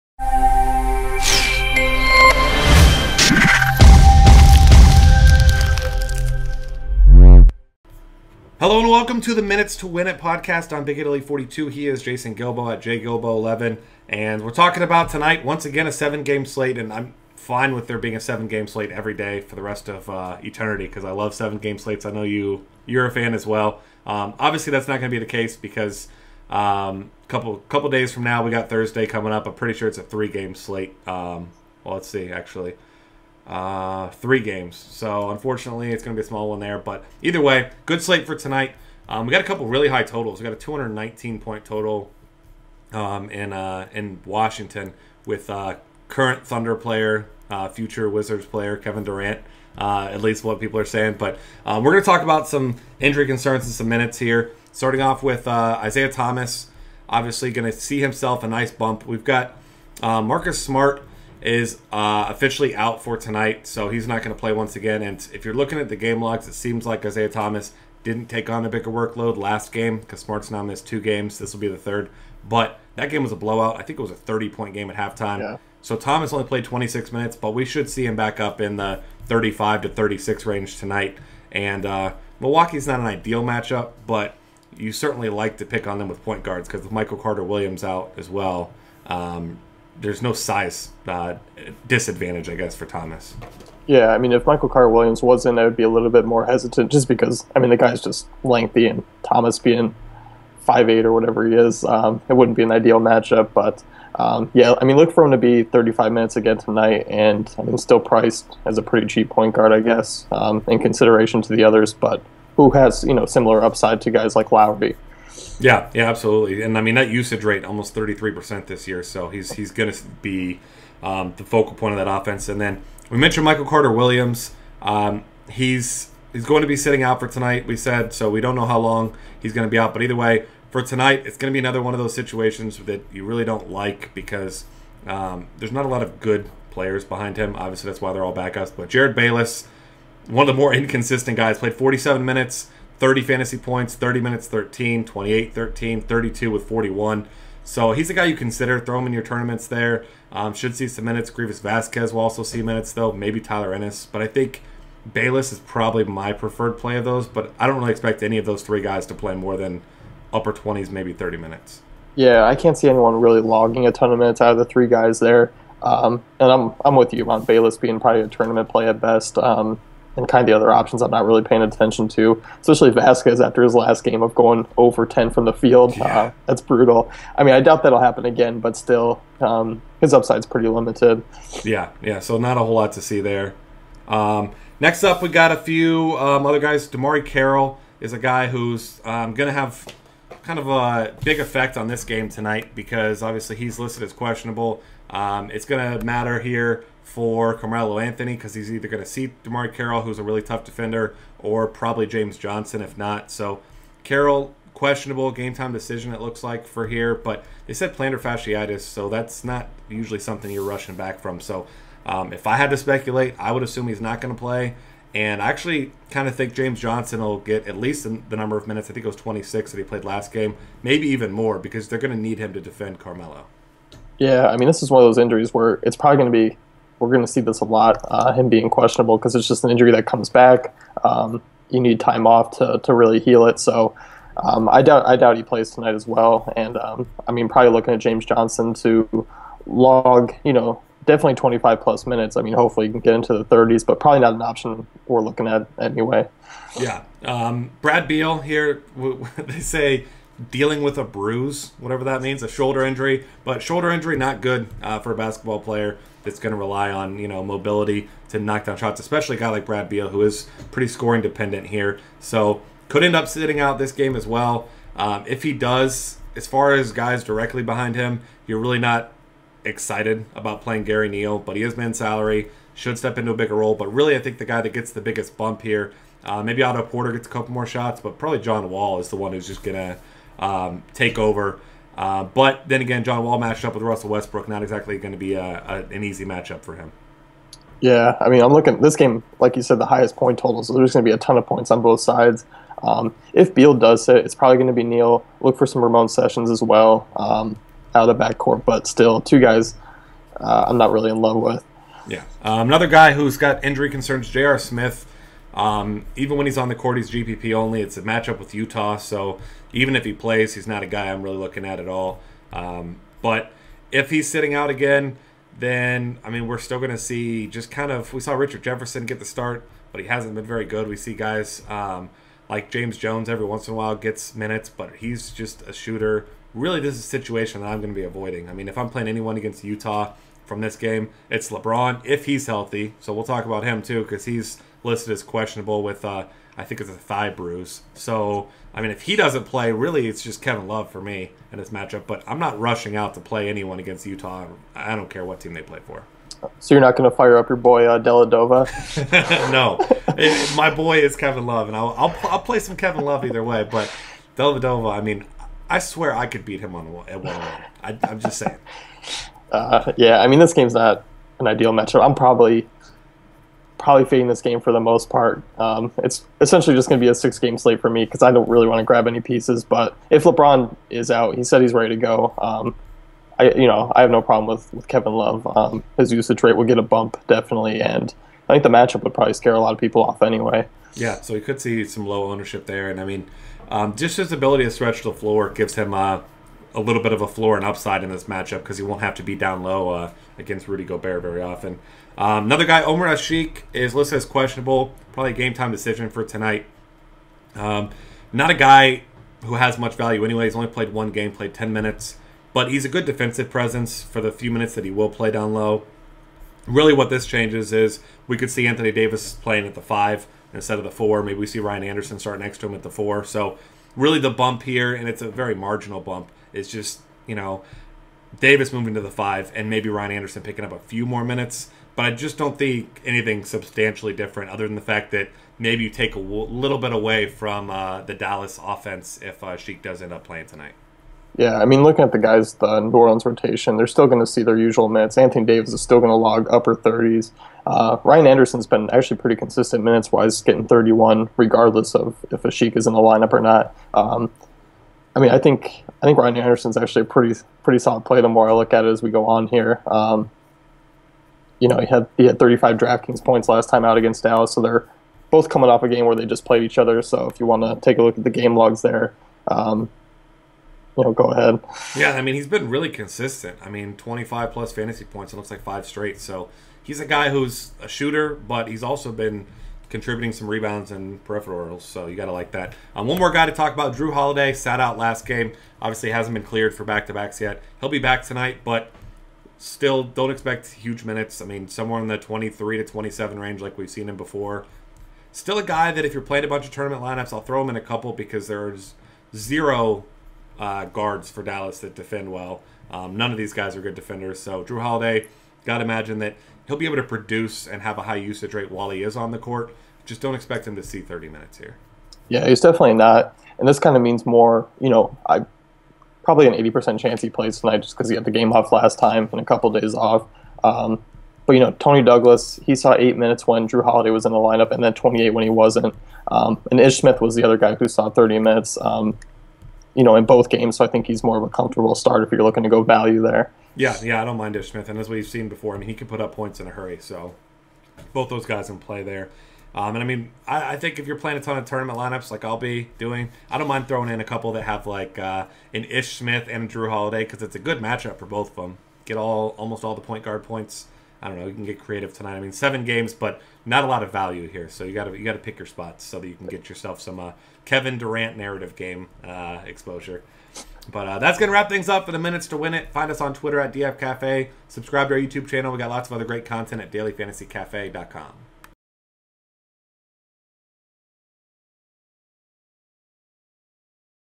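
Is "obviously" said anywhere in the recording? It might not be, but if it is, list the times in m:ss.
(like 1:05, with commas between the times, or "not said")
0:24, 0:57, 2:17, 3:13, 7:55.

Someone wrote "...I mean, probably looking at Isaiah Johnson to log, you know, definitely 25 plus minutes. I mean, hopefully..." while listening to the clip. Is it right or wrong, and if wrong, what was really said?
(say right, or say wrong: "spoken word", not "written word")
wrong: "James", not "Isaiah".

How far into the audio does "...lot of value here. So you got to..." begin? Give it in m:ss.
9:03.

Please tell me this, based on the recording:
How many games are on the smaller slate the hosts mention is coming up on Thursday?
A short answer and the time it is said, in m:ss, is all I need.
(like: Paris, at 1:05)
3, at 0:30.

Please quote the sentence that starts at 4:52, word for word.
Um, if Beal does it, it's probably going to be Neal.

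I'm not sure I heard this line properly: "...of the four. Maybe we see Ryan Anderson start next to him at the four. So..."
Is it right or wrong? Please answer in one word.
right.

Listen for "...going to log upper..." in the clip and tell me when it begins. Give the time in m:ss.
7:15.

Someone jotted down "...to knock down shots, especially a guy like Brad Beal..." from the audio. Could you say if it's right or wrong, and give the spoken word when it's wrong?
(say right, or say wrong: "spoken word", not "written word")
right.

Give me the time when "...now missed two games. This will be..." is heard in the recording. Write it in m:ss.
1:10.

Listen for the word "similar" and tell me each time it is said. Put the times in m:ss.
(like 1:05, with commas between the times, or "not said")
1:53.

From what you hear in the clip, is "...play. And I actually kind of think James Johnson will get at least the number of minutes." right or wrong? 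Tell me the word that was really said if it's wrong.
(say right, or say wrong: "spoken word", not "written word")
right.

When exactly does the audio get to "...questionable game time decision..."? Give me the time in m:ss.
3:24.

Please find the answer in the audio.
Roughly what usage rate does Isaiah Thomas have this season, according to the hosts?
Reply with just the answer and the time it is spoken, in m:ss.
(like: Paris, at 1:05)
33%, at 1:57.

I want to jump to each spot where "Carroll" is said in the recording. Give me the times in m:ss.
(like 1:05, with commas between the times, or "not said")
3:07, 3:19, 3:24.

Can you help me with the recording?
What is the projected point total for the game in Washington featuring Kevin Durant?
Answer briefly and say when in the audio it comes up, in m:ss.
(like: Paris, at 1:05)
219, at 0:40.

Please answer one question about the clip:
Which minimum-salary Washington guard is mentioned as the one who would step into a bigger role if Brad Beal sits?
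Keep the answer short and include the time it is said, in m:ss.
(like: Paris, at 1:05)
Gary Neal, at 4:30.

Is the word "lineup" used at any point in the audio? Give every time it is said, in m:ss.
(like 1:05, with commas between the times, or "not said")
7:22, 8:07, 8:34, 8:51.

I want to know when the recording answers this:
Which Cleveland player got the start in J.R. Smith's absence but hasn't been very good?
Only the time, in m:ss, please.
5:18.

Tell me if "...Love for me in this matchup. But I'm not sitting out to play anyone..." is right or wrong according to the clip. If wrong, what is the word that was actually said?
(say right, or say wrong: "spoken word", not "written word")
wrong: "rushing", not "sitting".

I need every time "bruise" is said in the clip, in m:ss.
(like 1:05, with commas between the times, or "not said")
4:11, 5:37.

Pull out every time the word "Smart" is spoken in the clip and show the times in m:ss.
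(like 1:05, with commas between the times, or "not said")
1:00, 1:10.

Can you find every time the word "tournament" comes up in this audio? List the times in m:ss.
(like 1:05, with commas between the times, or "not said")
2:29, 2:48, 8:06, 8:51.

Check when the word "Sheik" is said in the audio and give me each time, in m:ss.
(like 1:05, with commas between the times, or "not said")
7:09, 7:22.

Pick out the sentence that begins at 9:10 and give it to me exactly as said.
But uh, that's gonna wrap things up for the minutes to win it.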